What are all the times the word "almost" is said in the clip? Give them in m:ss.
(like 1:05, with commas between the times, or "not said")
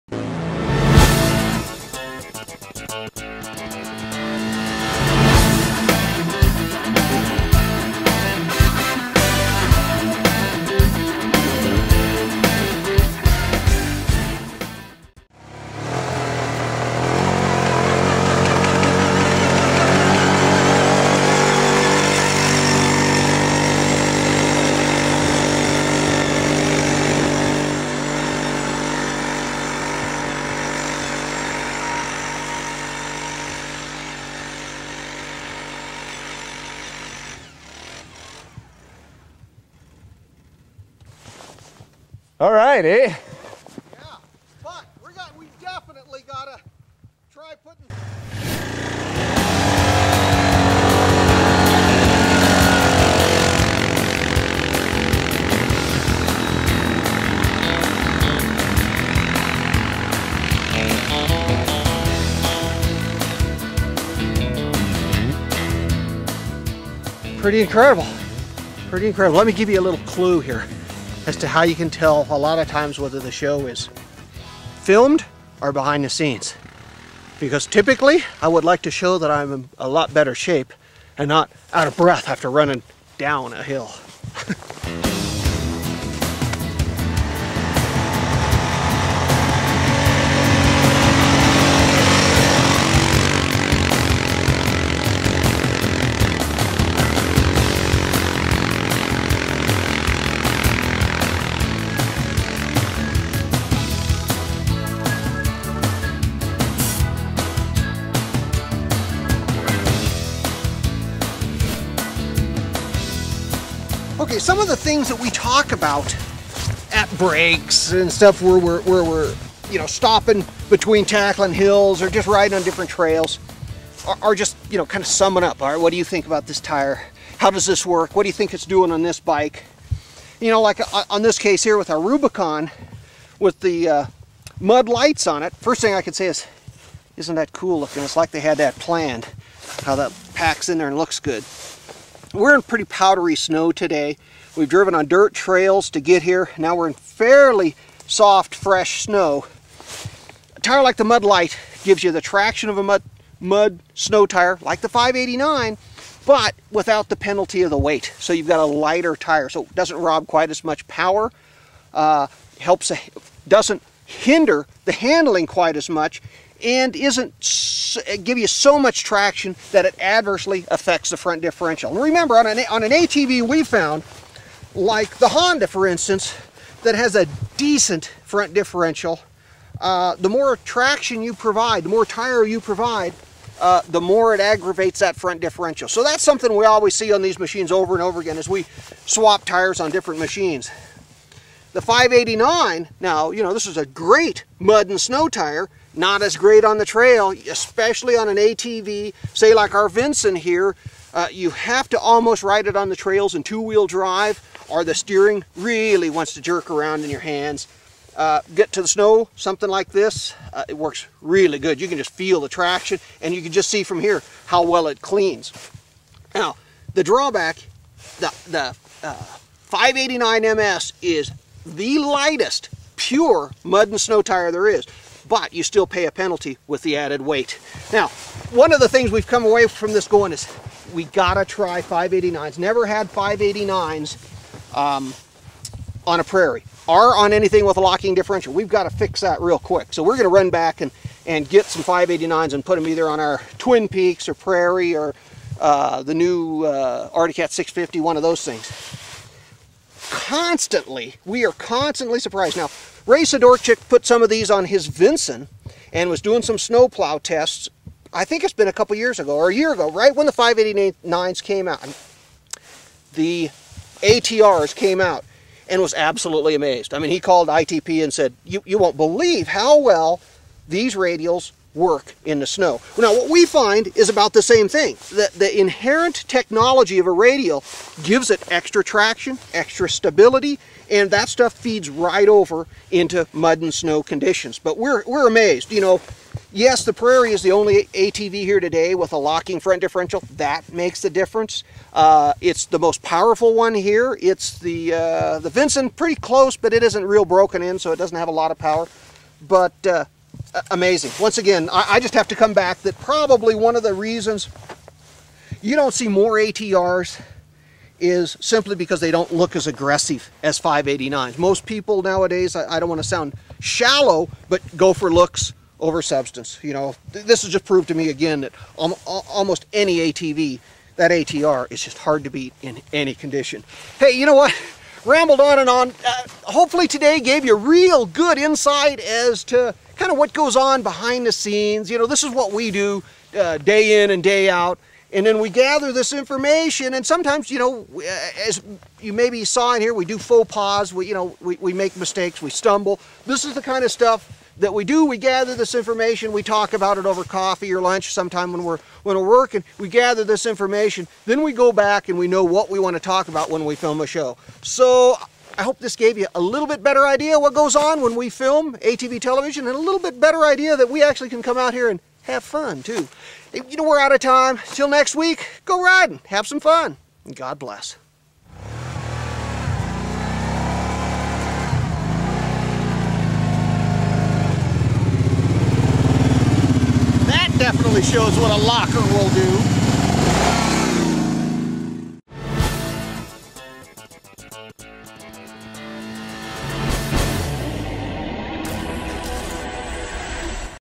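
3:21, 5:19.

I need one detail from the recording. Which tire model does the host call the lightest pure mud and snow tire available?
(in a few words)
589 MS.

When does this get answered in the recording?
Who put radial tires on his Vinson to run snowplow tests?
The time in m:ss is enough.
4:13.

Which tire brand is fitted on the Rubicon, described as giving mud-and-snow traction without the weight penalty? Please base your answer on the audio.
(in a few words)
Mud Lites.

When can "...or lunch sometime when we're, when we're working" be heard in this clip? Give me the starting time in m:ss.
5:47.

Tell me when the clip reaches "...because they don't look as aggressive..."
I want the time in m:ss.
5:08.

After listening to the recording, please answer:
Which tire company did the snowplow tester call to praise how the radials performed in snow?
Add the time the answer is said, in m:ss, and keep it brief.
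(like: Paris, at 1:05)
ITP, at 4:27.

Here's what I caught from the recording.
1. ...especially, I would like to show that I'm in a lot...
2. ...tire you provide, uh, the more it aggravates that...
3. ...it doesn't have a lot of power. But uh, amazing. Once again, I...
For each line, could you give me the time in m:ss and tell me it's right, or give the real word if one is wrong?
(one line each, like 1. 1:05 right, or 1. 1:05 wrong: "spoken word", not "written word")
1. 1:17 wrong: "typically", not "especially"
2. 3:02 right
3. 4:57 right.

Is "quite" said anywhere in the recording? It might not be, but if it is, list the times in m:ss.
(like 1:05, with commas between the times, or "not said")
2:40, 2:45.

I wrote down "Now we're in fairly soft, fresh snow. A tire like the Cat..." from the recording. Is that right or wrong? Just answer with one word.
wrong.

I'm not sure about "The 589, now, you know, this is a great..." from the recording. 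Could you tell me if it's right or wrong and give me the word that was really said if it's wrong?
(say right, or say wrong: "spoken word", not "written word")
right.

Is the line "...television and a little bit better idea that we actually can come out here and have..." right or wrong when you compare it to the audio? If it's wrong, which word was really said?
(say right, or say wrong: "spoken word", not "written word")
right.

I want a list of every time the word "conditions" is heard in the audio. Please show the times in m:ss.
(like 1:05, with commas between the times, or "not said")
4:44, 5:23.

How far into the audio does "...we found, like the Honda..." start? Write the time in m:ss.
2:53.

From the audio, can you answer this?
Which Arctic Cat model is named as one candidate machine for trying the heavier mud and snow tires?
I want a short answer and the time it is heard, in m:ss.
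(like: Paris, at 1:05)
Arctic Cat 650, at 4:07.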